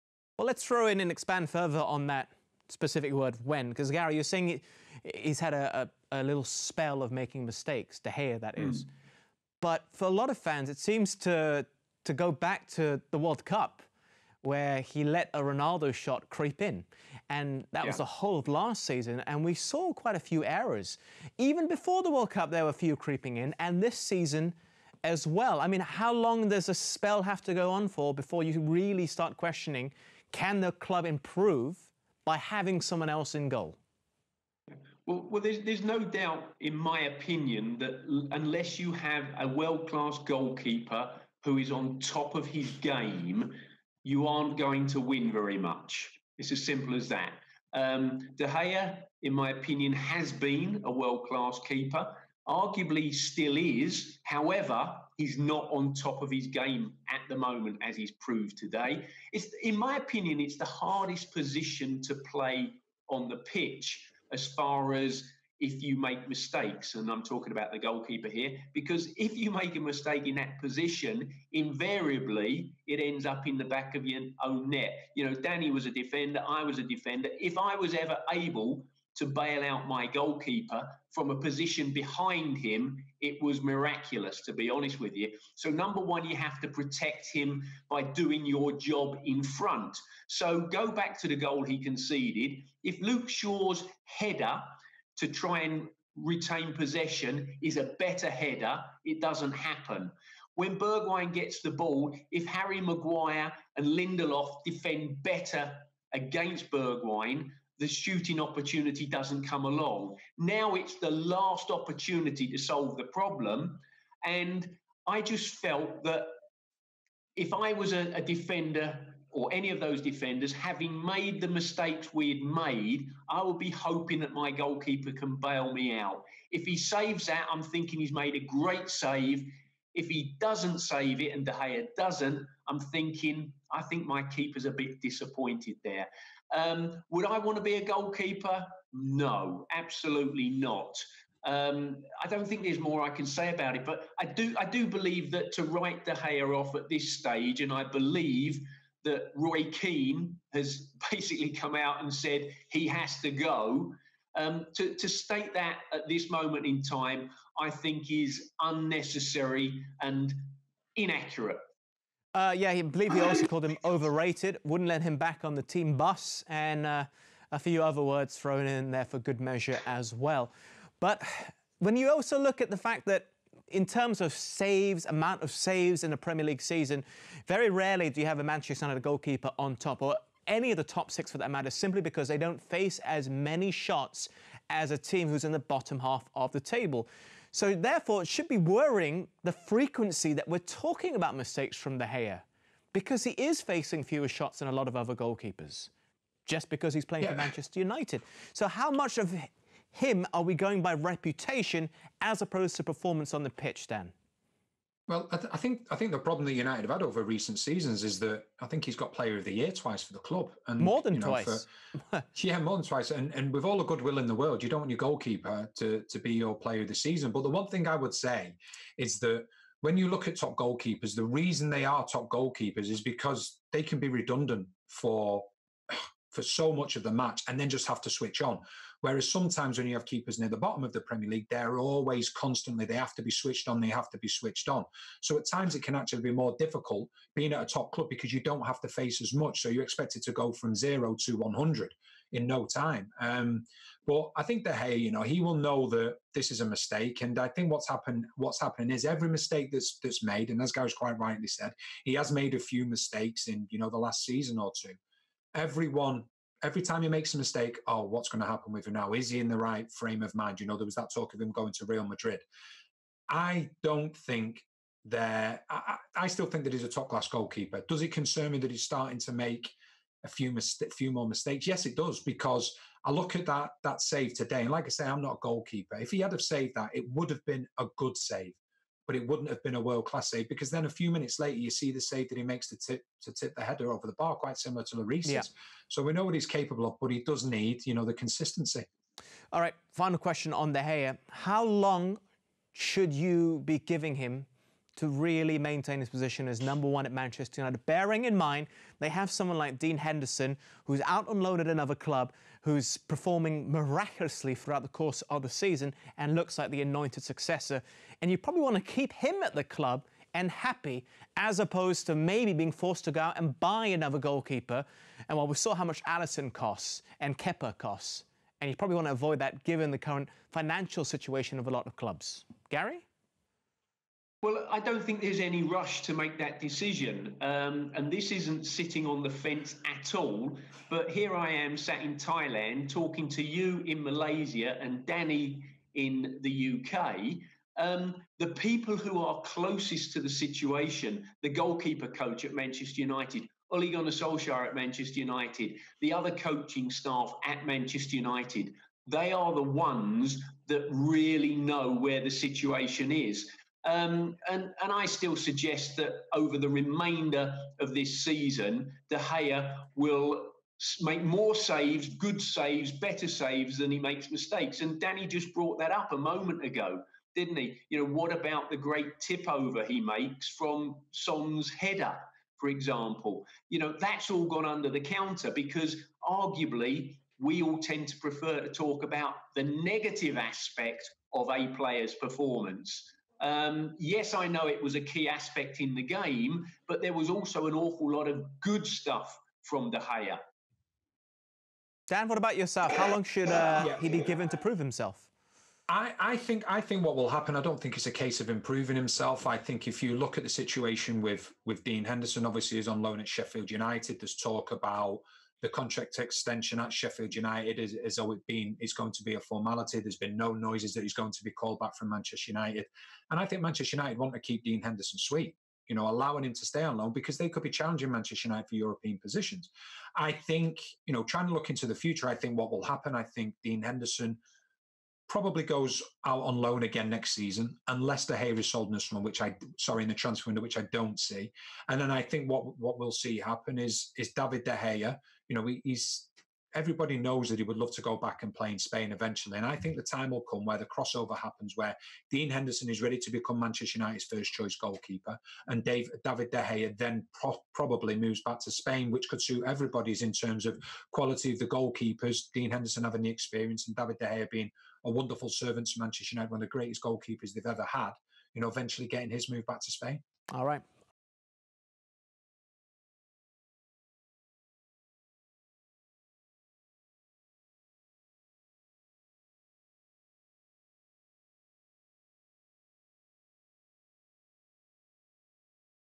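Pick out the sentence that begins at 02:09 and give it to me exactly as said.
If he doesn't save it and De Gea doesn't, I'm thinking I think my keeper's a bit disappointed there.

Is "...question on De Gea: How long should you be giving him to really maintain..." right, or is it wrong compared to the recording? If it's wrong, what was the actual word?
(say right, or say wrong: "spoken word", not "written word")
right.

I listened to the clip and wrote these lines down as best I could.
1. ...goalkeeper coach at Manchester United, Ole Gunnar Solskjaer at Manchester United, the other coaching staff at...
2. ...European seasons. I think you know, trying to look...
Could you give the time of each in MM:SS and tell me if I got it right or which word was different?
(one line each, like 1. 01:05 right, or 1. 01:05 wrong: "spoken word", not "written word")
1. 05:41 right
2. 06:58 wrong: "positions", not "seasons".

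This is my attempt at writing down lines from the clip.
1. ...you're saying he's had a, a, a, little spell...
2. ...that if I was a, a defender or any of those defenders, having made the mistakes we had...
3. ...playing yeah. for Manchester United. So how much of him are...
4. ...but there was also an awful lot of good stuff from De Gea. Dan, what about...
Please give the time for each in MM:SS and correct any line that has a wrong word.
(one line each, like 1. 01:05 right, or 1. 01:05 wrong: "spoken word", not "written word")
1. 00:04 right
2. 01:56 right
3. 03:17 right
4. 06:26 right.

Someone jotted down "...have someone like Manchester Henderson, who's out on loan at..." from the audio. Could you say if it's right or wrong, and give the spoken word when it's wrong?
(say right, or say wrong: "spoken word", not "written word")
wrong: "Dean", not "Manchester".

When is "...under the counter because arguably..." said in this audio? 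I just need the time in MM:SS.
06:14.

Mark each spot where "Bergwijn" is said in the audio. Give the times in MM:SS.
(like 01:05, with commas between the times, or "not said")
01:40, 01:46.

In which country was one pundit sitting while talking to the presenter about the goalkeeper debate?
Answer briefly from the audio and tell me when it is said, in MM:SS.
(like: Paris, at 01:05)
Thailand, at 05:32.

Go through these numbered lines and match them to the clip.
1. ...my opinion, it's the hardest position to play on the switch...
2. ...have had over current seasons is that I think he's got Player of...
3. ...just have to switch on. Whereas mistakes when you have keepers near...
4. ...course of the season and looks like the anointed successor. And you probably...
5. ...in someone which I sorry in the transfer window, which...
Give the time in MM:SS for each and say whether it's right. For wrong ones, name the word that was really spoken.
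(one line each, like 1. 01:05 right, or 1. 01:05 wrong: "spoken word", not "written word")
1. 00:59 wrong: "pitch", not "switch"
2. 03:26 wrong: "recent", not "current"
3. 03:47 wrong: "sometimes", not "mistakes"
4. 05:04 right
5. 07:08 right.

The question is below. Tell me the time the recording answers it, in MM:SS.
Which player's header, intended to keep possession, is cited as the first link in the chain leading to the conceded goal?
01:33.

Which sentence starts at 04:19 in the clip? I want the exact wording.
Is he in the right frame of mind?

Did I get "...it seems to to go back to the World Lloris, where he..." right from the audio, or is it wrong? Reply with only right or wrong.
wrong.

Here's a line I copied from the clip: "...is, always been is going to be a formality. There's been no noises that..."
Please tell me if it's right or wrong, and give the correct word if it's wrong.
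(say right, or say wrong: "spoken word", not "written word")
right.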